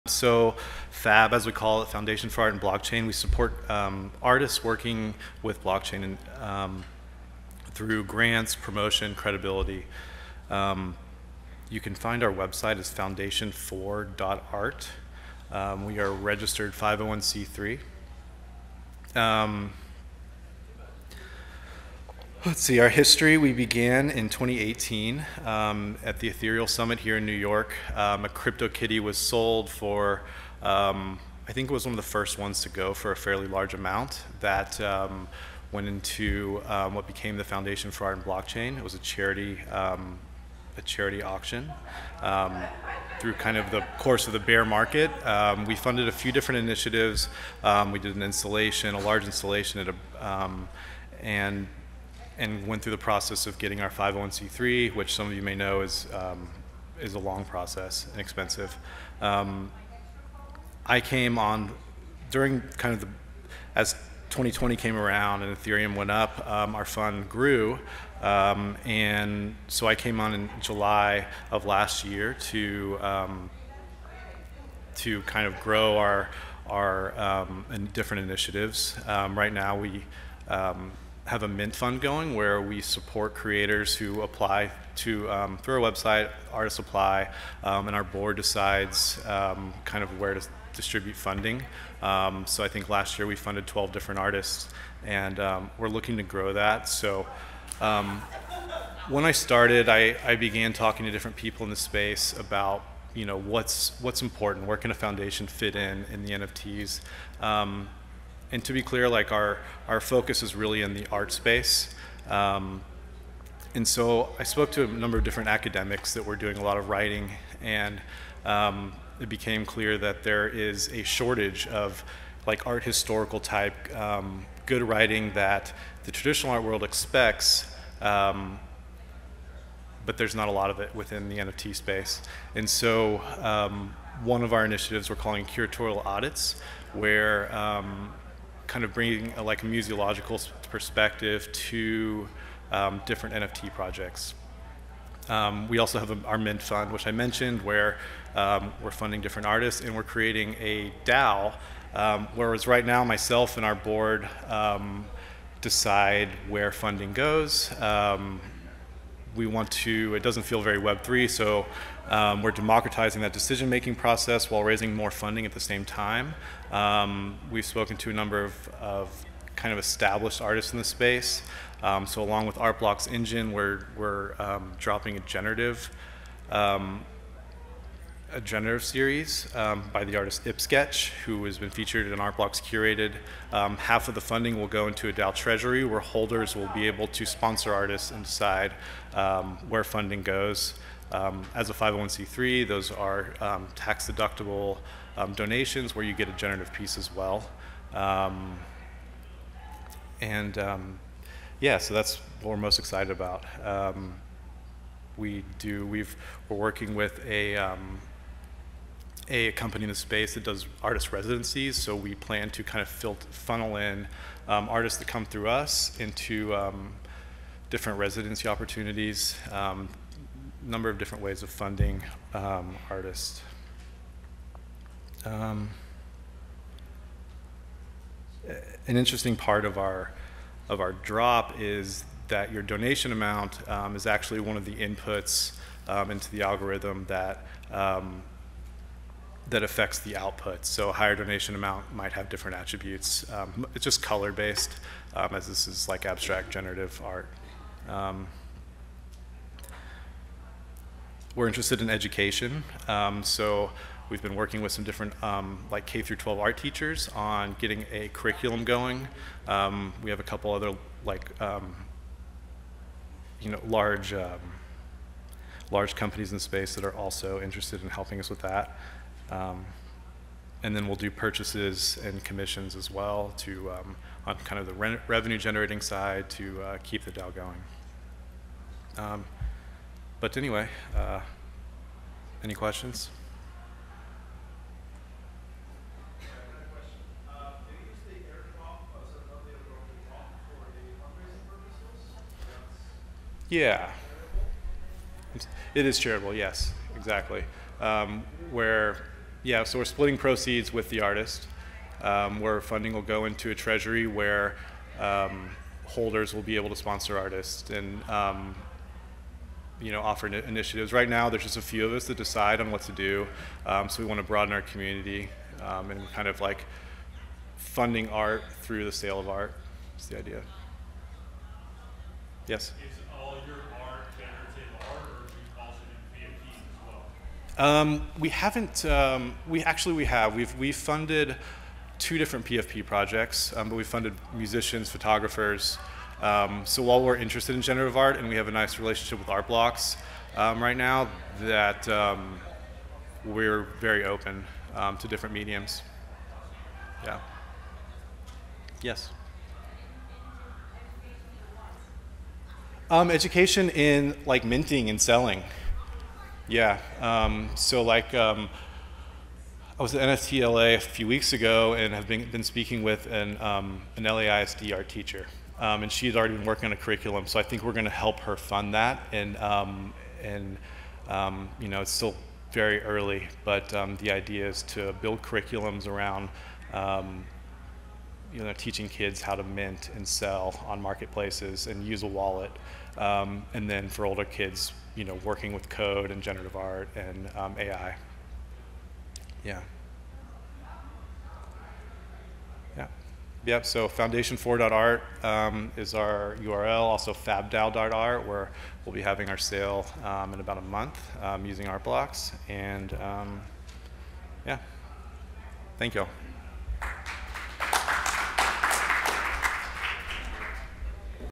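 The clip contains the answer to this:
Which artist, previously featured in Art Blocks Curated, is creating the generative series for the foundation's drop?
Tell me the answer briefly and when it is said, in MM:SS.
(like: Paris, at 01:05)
ippsketch, at 03:00.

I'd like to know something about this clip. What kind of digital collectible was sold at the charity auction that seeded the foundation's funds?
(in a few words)
CryptoKitty.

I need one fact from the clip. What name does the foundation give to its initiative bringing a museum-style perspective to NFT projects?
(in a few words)
curatorial audits.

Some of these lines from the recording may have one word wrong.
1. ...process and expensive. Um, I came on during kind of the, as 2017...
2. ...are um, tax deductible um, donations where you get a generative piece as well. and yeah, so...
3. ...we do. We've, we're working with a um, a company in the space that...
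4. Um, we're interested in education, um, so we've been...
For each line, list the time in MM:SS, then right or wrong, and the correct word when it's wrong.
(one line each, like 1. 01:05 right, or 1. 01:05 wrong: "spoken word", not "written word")
1. 00:57 wrong: "2020", not "2017"
2. 03:12 right
3. 03:25 right
4. 04:07 right.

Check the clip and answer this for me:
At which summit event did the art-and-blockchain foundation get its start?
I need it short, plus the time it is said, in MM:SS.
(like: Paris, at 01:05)
Ethereal Summit, at 00:26.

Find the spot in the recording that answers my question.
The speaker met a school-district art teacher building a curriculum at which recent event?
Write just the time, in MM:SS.
06:00.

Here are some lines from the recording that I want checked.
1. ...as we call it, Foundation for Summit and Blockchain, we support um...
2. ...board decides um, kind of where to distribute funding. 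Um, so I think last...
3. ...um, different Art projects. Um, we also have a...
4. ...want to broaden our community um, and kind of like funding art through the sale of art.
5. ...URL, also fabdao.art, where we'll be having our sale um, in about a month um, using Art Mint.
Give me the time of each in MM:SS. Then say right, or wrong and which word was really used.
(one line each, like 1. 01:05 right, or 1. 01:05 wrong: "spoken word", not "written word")
1. 00:01 wrong: "Art", not "Summit"
2. 01:28 right
3. 02:22 wrong: "NFT", not "Art"
4. 05:14 right
5. 06:36 wrong: "Blocks", not "Mint".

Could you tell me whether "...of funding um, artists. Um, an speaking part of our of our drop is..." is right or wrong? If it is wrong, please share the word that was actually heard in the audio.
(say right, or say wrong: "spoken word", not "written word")
wrong: "interesting", not "speaking".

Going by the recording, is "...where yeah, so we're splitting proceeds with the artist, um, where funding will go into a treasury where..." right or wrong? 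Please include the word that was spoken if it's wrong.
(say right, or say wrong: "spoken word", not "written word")
right.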